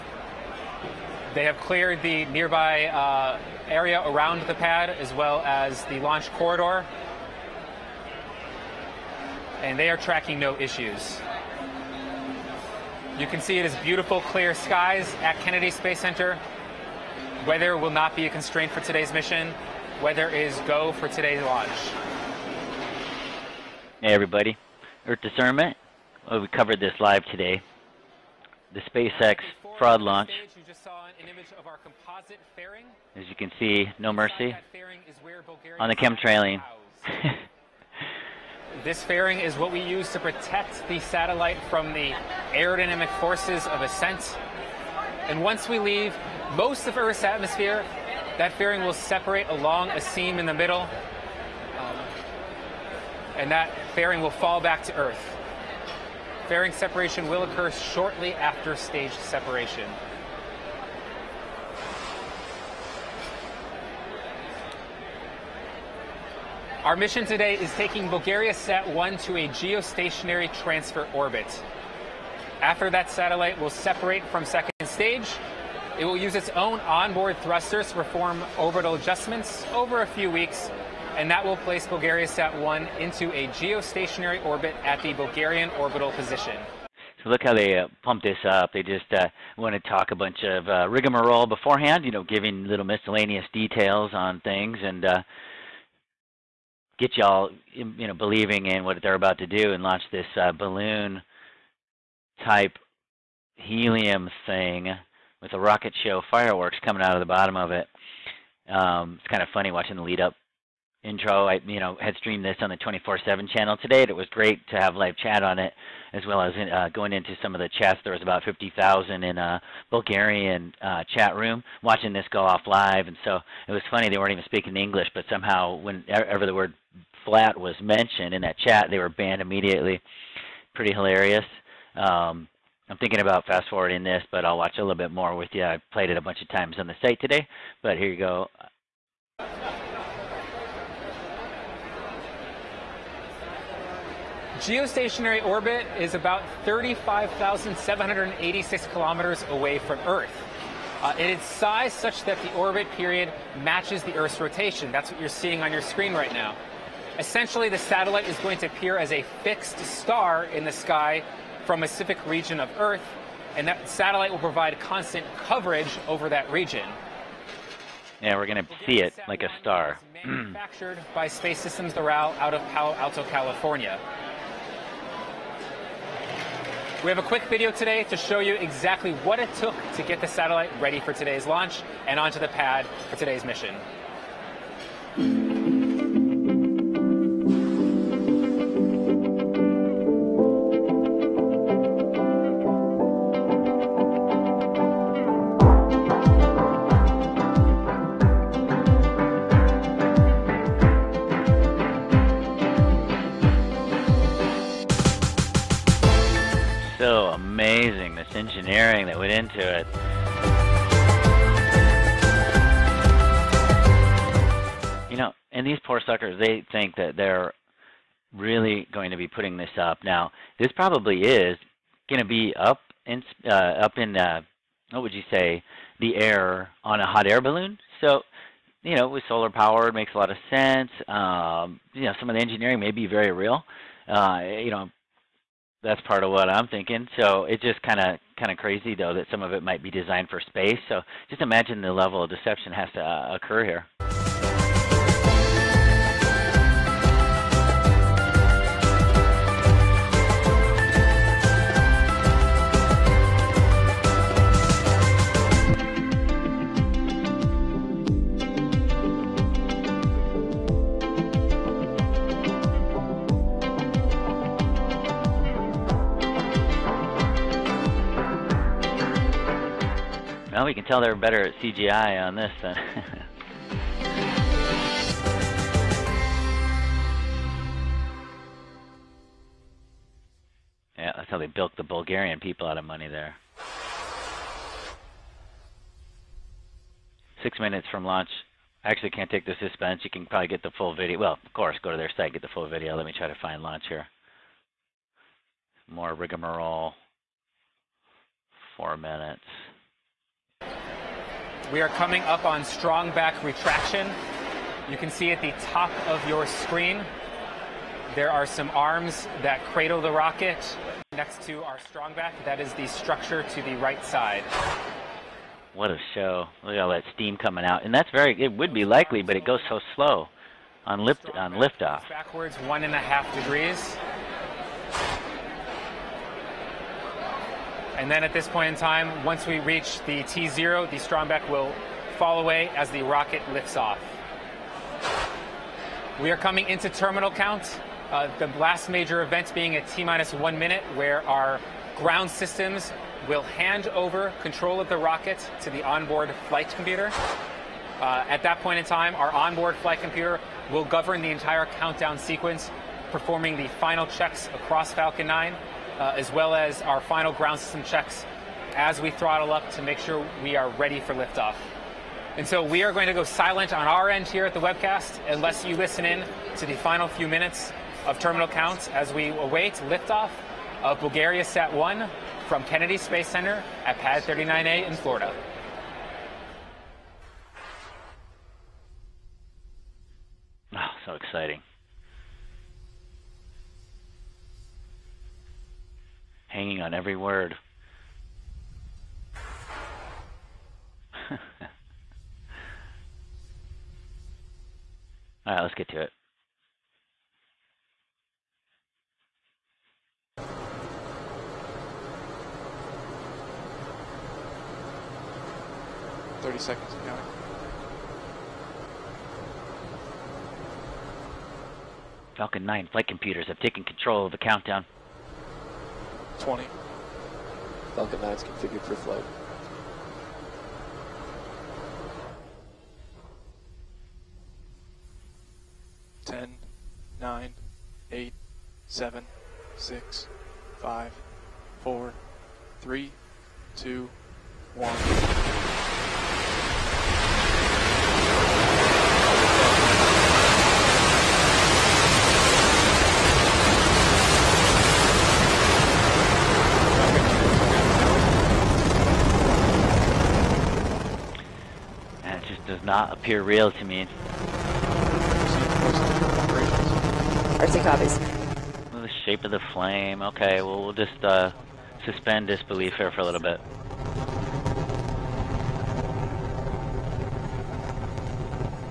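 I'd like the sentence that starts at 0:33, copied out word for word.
As you can see, no mercy on the chemtrailing.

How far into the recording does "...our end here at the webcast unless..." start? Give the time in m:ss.
6:03.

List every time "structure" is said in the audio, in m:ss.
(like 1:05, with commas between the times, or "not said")
5:12.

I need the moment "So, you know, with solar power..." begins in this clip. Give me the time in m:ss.
3:48.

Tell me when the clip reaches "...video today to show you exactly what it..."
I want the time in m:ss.
2:57.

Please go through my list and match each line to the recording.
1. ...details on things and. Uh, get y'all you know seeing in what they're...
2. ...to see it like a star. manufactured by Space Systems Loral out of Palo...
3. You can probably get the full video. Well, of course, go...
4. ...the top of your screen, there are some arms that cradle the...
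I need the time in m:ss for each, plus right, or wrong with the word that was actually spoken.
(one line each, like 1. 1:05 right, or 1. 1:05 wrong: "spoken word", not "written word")
1. 1:33 wrong: "believing", not "seeing"
2. 2:48 right
3. 4:50 right
4. 5:05 right.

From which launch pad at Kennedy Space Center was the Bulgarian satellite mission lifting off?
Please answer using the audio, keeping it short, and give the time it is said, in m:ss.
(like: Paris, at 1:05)
Pad 39A, at 6:13.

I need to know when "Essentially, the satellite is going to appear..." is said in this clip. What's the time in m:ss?
2:37.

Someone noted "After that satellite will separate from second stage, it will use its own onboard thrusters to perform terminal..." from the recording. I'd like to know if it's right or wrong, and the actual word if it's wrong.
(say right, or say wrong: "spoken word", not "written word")
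wrong: "orbital", not "terminal".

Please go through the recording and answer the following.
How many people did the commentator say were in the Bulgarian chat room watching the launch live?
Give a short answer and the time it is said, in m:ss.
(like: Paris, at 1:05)
50,000, at 1:58.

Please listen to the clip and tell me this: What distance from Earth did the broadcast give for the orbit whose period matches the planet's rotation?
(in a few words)
35,786 kilometers.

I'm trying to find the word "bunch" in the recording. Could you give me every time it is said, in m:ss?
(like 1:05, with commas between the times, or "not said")
1:30, 2:16.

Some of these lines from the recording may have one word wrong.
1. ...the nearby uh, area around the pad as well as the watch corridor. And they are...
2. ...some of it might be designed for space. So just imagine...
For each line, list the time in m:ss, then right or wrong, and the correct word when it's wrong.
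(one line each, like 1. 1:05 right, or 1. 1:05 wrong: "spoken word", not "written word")
1. 0:02 wrong: "launch", not "watch"
2. 3:59 right.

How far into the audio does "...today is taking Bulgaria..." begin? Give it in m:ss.
1:07.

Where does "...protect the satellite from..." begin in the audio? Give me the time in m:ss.
0:40.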